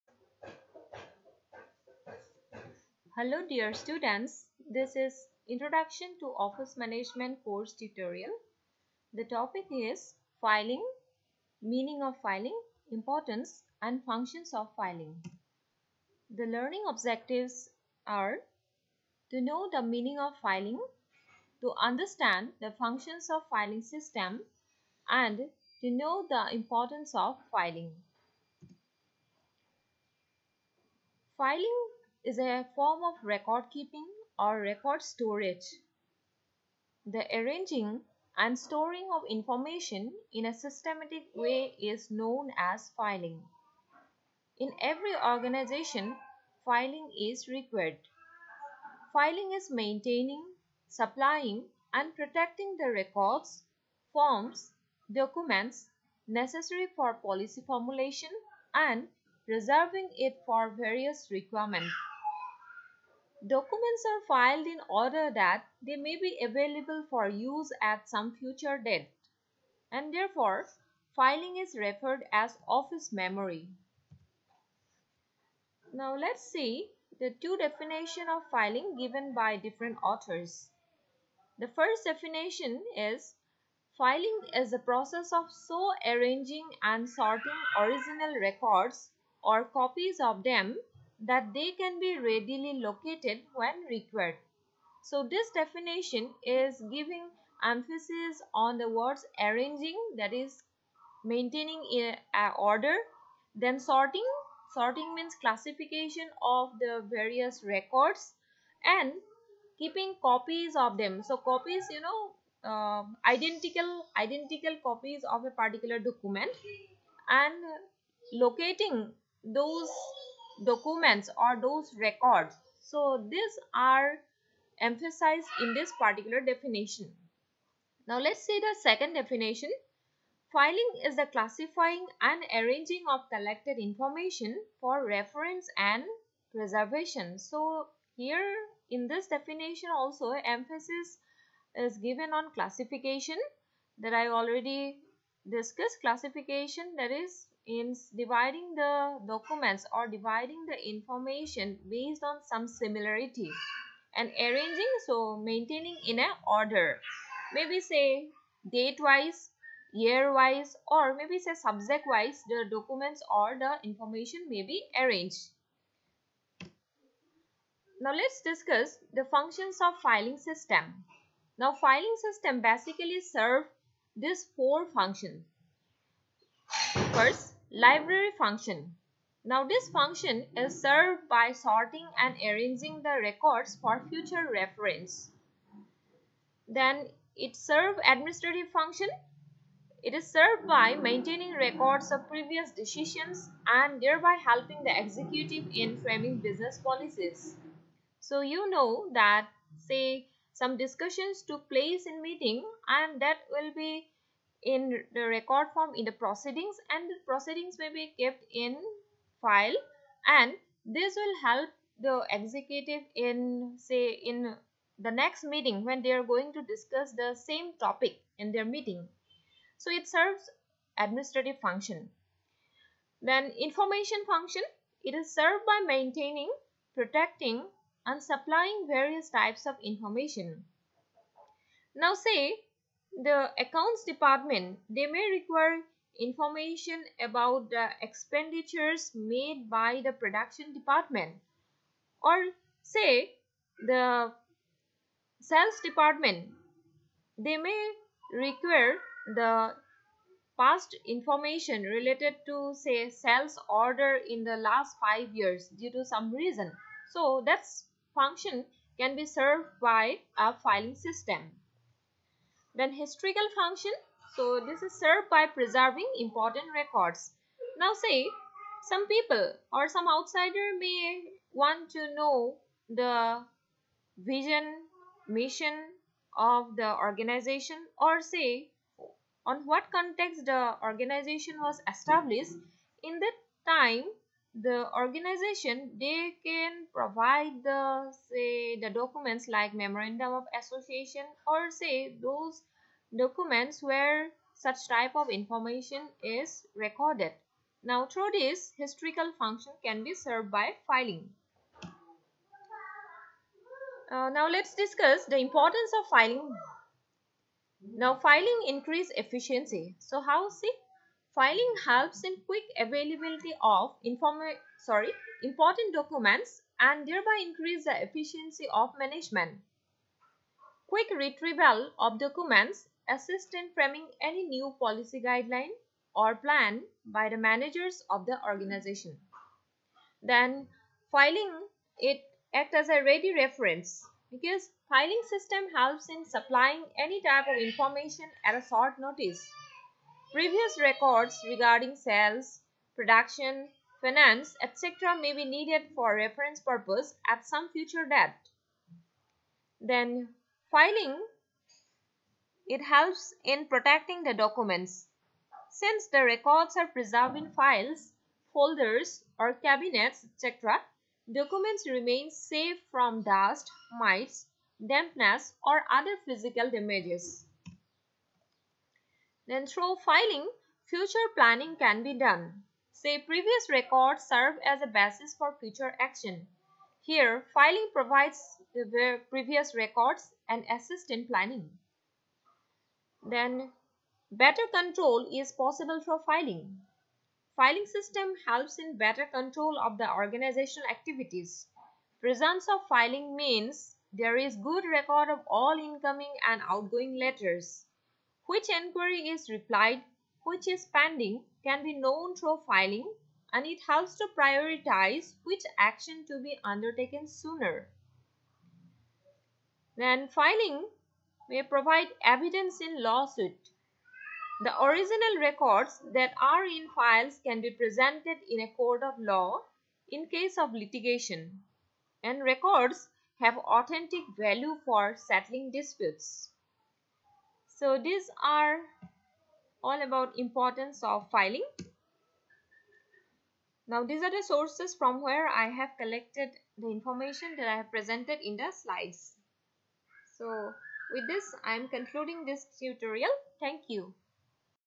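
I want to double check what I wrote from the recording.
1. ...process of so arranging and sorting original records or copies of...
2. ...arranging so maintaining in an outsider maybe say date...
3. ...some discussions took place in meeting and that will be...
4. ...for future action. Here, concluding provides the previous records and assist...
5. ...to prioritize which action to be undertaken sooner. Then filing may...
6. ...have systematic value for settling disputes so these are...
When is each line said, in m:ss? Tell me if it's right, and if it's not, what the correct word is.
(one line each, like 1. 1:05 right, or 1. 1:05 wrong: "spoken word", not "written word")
1. 1:24 right
2. 2:34 wrong: "order", not "outsider"
3. 3:20 right
4. 6:15 wrong: "filing", not "concluding"
5. 6:44 right
6. 7:03 wrong: "authentic", not "systematic".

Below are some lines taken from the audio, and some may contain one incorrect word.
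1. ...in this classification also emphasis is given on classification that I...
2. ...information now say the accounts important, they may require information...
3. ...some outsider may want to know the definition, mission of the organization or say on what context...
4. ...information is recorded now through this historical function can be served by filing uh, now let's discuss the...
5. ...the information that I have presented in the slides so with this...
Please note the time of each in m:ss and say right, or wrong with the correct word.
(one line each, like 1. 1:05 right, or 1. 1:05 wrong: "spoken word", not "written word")
1. 2:18 wrong: "definition", not "classification"
2. 3:49 wrong: "department", not "important"
3. 4:29 wrong: "vision", not "definition"
4. 4:55 right
5. 7:16 right.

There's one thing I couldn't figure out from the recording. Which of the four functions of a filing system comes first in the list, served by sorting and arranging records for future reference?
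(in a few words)
Library function.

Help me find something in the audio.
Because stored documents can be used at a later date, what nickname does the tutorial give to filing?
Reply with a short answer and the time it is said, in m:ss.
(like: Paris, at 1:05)
Office memory, at 1:12.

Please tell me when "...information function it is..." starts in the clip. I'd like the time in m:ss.
3:43.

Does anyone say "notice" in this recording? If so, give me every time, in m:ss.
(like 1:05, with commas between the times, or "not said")
5:38.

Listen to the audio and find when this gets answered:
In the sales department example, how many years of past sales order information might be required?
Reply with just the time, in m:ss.
4:14.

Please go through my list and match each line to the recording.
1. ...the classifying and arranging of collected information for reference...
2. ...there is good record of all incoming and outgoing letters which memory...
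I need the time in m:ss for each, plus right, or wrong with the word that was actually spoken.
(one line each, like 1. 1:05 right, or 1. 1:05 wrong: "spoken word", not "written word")
1. 2:11 right
2. 6:34 wrong: "enquiry", not "memory".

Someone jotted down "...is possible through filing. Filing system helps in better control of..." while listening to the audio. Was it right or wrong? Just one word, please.
right.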